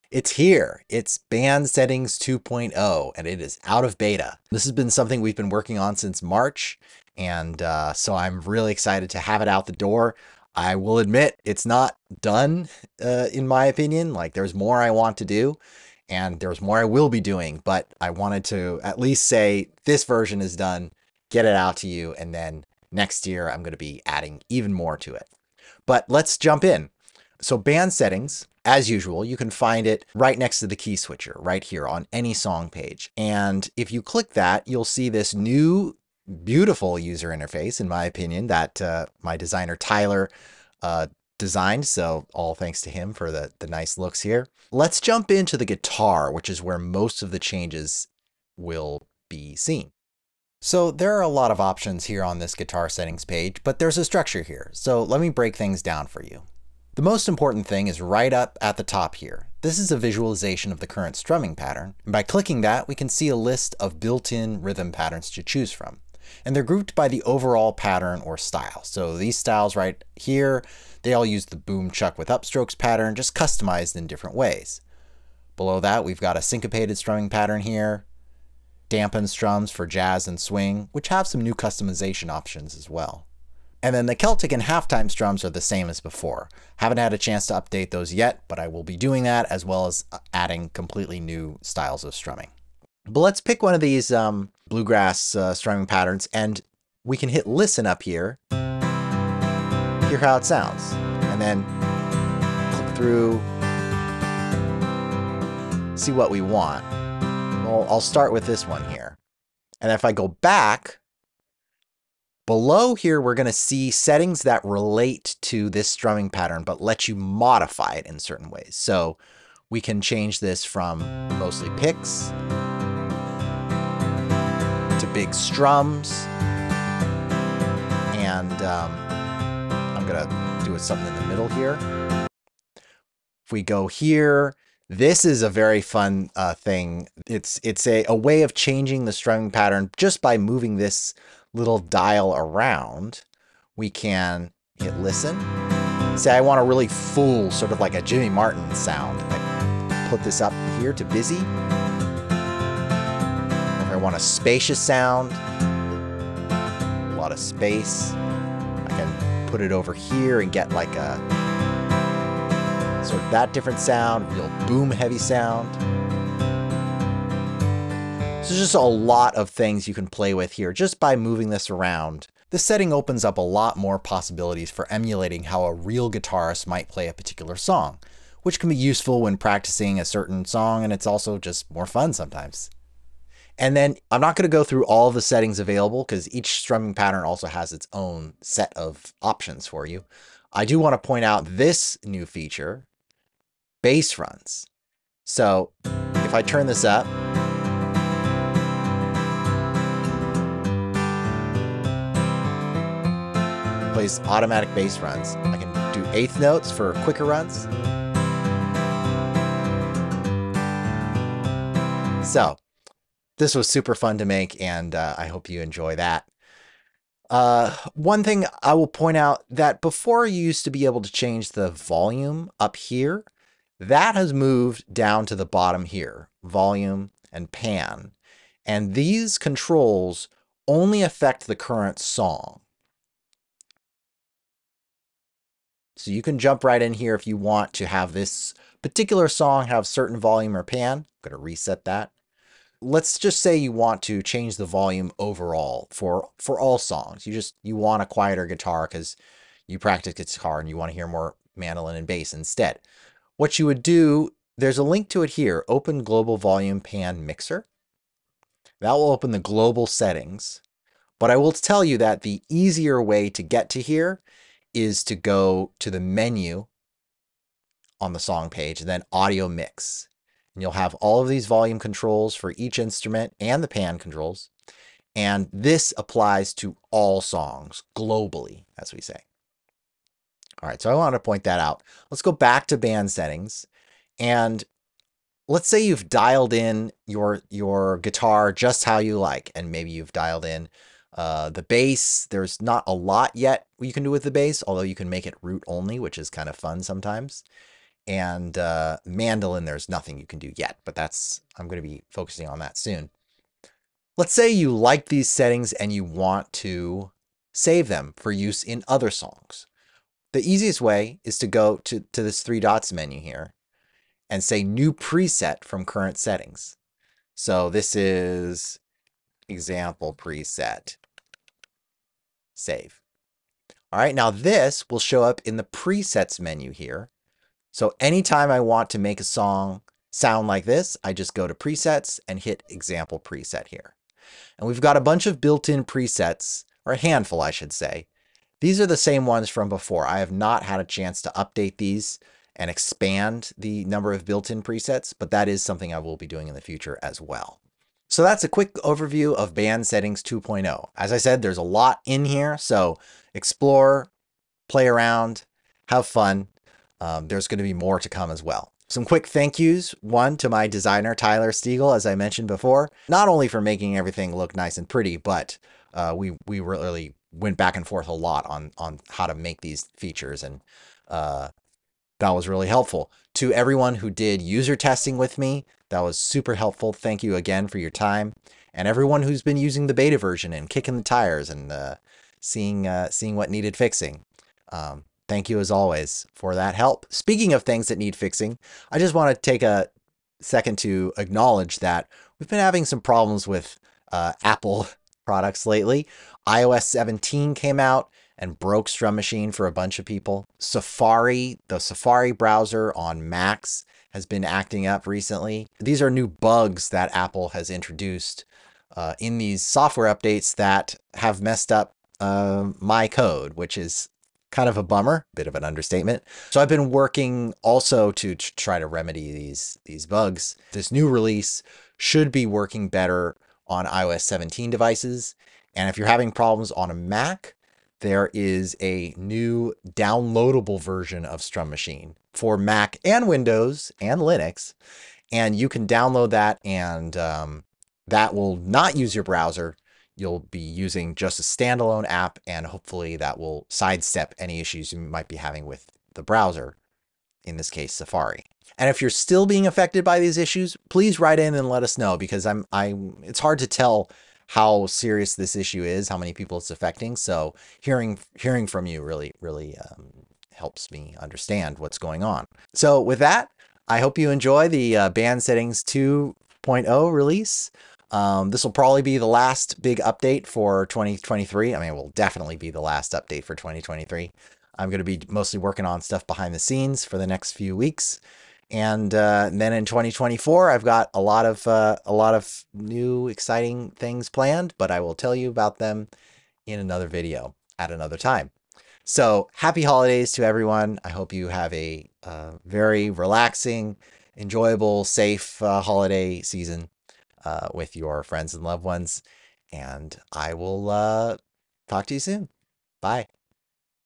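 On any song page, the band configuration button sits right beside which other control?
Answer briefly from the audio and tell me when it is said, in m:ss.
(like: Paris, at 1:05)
The key switcher, at 0:30.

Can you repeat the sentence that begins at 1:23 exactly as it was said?
And then the Celtic and halftime strums are the same as before.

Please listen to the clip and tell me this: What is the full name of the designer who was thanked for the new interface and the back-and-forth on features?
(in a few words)
Tyler Stiegel.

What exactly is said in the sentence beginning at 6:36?
iOS 17 came out and broke Strum Machine for a bunch of people.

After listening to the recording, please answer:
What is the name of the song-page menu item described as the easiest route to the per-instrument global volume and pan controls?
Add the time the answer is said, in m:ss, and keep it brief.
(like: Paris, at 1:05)
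Audio mix, at 4:29.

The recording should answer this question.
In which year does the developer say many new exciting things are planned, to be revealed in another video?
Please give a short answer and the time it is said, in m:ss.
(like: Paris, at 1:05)
2024, at 7:59.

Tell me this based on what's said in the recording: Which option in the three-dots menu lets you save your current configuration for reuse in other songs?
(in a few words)
New preset from current settings.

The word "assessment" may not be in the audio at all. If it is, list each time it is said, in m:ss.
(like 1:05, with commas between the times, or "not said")
not said.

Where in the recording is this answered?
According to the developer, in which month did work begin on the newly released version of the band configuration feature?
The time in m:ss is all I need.
0:06.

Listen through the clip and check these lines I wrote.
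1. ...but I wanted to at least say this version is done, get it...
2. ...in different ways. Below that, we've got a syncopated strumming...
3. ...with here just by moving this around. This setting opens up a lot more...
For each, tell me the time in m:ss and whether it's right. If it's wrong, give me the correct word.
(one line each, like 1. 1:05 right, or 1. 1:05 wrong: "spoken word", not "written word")
1. 0:17 right
2. 1:13 right
3. 2:50 right.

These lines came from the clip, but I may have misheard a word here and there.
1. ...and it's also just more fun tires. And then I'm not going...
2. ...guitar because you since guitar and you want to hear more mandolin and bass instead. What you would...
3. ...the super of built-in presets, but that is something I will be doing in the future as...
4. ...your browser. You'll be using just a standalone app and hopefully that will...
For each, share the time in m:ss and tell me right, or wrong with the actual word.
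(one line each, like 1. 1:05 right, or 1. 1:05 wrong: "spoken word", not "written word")
1. 3:00 wrong: "sometimes", not "tires"
2. 4:08 wrong: "practice", not "since"
3. 5:43 wrong: "number", not "super"
4. 7:19 right.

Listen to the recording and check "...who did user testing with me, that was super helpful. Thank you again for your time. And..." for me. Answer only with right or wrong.
right.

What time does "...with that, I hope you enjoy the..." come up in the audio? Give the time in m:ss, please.
7:43.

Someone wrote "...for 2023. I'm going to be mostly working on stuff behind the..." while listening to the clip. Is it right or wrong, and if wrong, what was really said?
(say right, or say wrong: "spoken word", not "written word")
right.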